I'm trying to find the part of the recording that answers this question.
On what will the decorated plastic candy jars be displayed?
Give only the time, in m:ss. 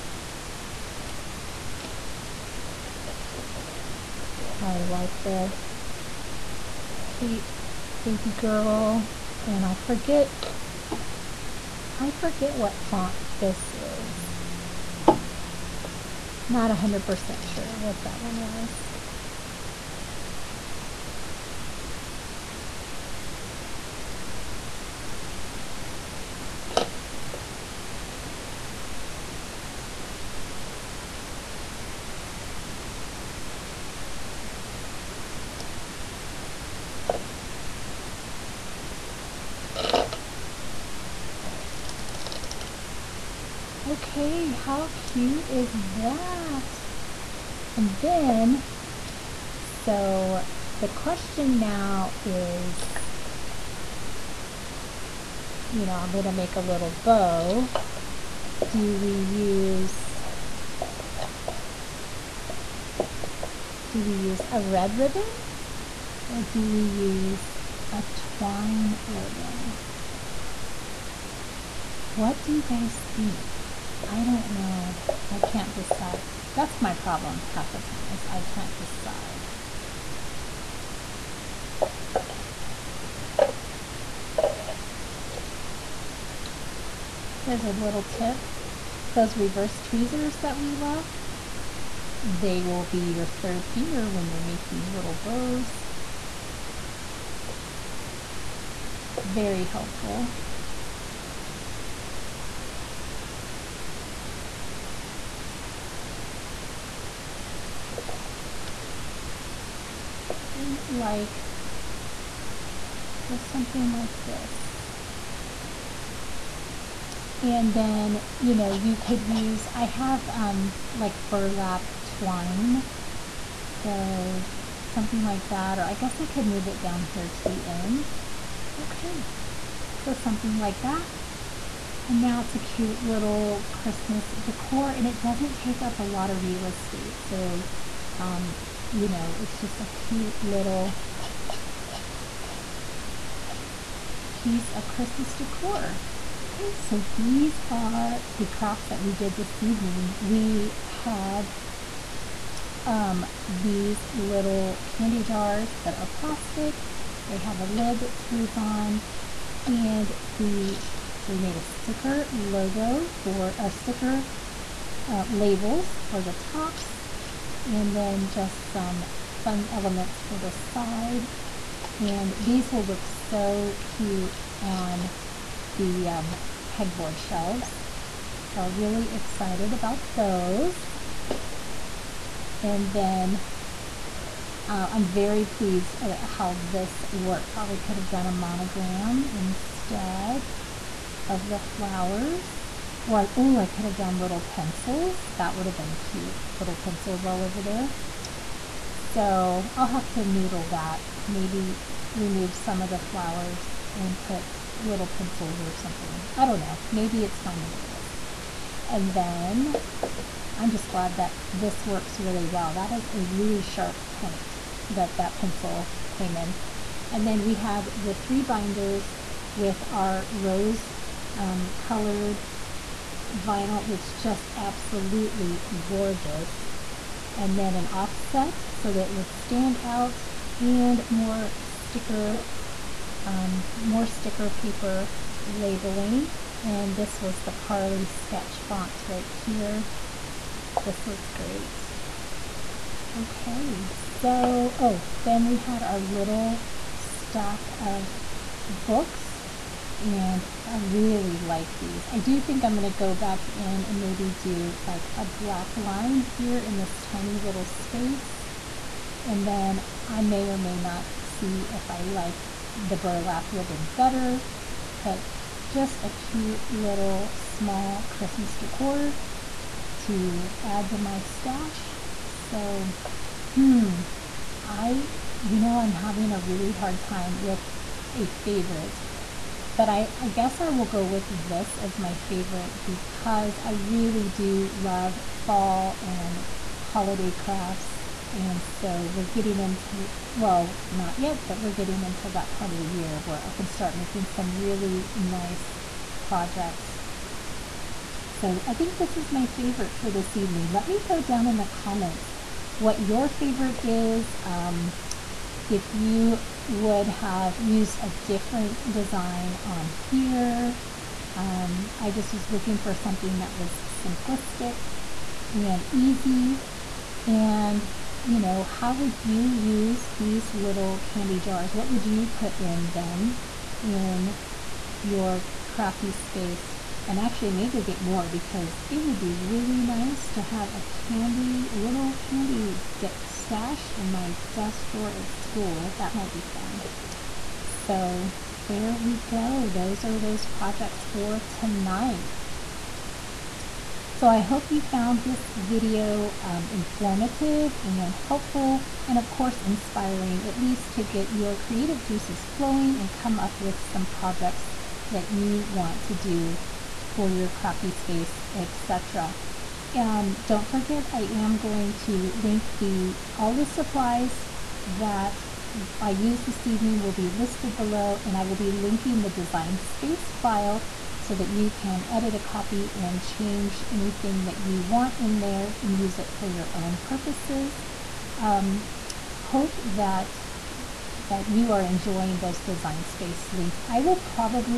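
2:56.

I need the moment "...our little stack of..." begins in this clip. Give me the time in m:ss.
4:05.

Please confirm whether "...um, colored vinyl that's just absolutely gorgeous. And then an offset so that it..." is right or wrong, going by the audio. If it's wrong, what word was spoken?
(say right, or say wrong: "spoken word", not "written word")
right.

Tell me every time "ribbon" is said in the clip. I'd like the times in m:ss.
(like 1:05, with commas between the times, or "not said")
1:04, 1:09, 4:23.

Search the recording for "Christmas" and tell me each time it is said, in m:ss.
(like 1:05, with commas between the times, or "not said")
2:13, 2:24, 4:28.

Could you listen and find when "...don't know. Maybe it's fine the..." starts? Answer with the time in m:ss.
3:26.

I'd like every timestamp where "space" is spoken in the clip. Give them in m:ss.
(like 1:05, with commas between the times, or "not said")
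4:17, 5:26, 5:57, 6:09, 6:23.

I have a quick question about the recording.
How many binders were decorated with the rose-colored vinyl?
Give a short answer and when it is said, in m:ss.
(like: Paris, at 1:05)
3, at 3:38.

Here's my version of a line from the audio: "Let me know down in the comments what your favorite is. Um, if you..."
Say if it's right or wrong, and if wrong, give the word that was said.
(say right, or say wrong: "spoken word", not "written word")
right.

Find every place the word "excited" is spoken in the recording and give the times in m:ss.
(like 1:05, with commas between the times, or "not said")
2:59.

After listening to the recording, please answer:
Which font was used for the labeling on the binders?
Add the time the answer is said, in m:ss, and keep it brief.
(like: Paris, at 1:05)
Carly sketch, at 3:57.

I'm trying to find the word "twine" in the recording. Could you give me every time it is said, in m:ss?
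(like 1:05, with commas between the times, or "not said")
1:08, 2:02.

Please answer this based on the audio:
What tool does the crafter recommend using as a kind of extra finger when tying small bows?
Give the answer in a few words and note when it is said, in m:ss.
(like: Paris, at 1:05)
Reverse tweezers, at 1:29.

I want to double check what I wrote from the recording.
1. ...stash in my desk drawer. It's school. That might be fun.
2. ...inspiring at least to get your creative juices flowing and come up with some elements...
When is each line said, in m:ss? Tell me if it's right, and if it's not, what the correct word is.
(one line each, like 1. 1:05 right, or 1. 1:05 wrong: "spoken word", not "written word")
1. 5:33 right
2. 5:49 wrong: "projects", not "elements".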